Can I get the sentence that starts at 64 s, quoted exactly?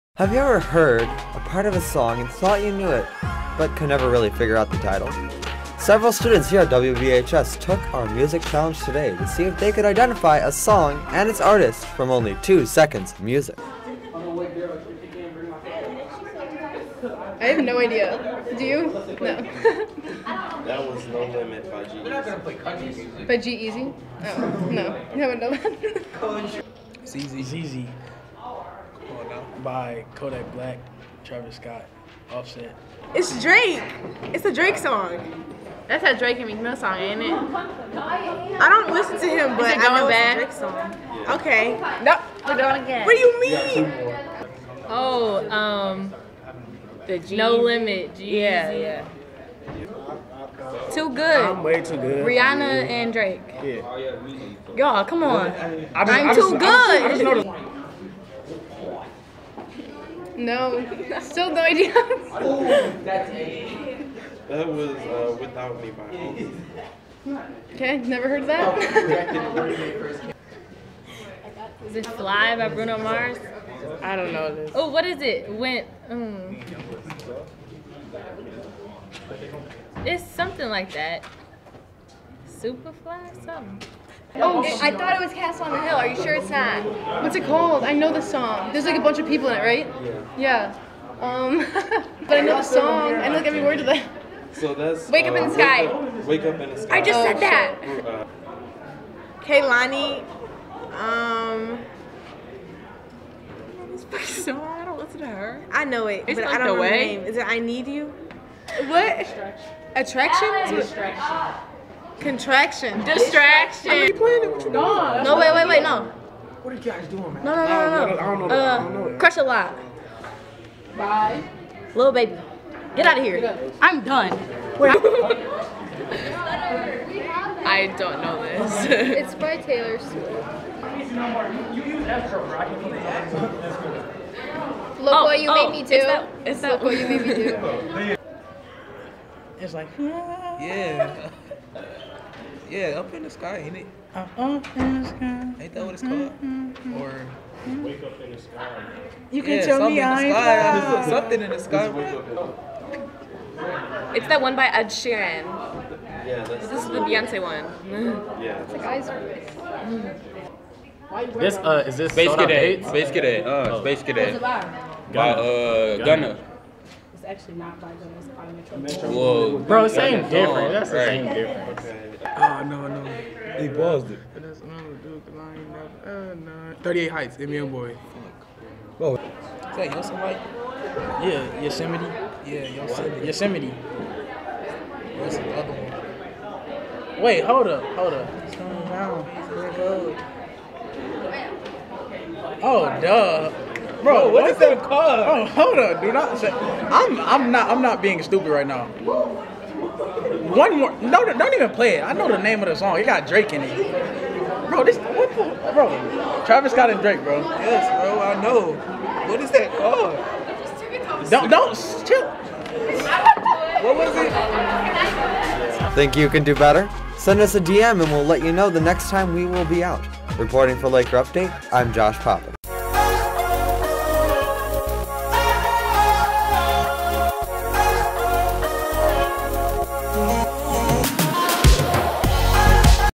That was uh, Without Me by Home.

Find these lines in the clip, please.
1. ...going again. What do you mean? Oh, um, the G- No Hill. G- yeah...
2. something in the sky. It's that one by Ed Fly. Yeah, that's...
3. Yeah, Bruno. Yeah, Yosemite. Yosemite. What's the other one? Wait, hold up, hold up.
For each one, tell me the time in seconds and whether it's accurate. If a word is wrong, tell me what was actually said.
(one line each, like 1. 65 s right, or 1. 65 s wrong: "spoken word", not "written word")
1. 42 s wrong: "Limit", not "Hill"
2. 151 s wrong: "Sheeran", not "Fly"
3. 181 s wrong: "Yosemite", not "Bruno".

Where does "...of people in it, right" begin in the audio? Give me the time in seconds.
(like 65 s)
89 s.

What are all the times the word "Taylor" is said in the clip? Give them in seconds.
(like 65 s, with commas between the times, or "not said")
129 s.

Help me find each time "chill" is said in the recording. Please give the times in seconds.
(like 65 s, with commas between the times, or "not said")
212 s.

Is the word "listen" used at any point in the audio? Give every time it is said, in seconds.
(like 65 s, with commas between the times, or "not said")
38 s, 104 s.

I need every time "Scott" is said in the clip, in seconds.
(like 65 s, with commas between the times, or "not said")
31 s, 206 s.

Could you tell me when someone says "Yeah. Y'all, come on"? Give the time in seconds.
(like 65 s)
53 s.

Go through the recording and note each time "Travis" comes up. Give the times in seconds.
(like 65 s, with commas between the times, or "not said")
31 s, 206 s.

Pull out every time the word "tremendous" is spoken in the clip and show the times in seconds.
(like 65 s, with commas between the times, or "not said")
not said.